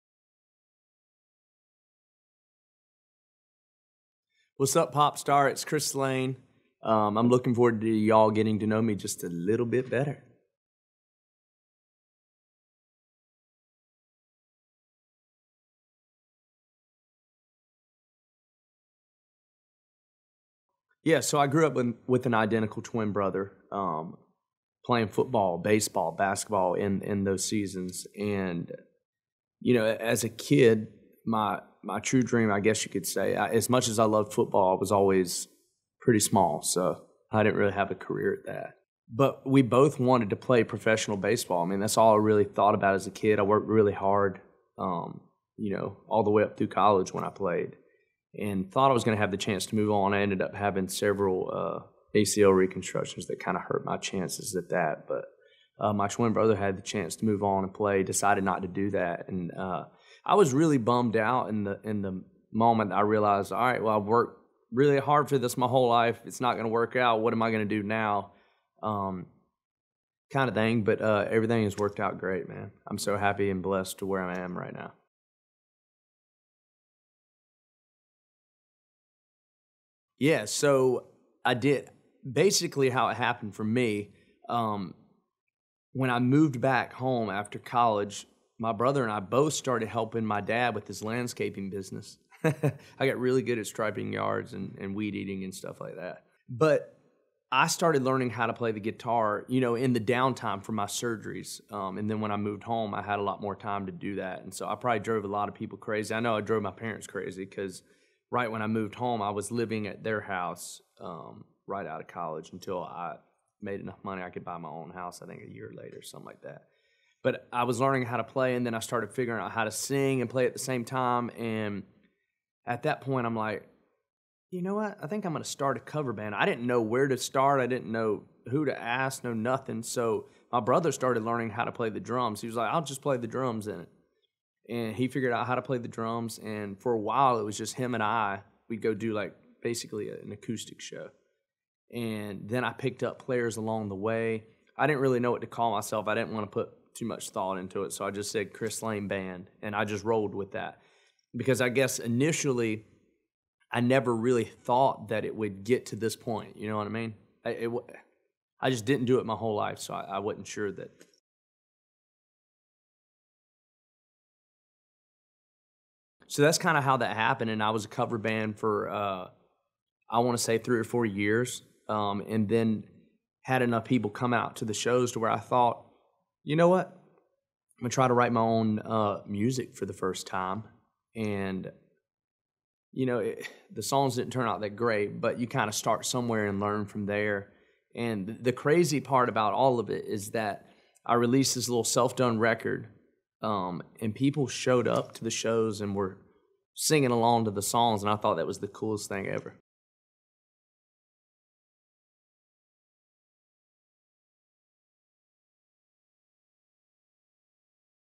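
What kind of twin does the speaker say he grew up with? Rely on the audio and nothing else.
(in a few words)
Identical twin brother.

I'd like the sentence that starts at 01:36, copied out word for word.
But I started learning how to play the guitar, you know, in the downtime for my surgeries.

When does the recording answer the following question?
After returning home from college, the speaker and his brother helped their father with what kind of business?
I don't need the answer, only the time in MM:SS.
01:31.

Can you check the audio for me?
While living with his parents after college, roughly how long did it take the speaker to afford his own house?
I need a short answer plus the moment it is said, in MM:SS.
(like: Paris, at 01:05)
A year, at 01:55.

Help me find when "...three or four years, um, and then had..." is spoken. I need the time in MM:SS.
02:50.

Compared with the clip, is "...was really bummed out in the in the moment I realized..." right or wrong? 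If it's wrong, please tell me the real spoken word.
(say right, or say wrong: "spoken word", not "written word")
right.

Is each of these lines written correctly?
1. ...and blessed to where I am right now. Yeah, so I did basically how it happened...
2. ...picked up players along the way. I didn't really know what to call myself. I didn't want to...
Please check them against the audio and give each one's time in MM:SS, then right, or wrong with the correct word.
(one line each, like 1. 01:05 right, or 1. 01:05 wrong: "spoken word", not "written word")
1. 01:13 right
2. 02:22 right.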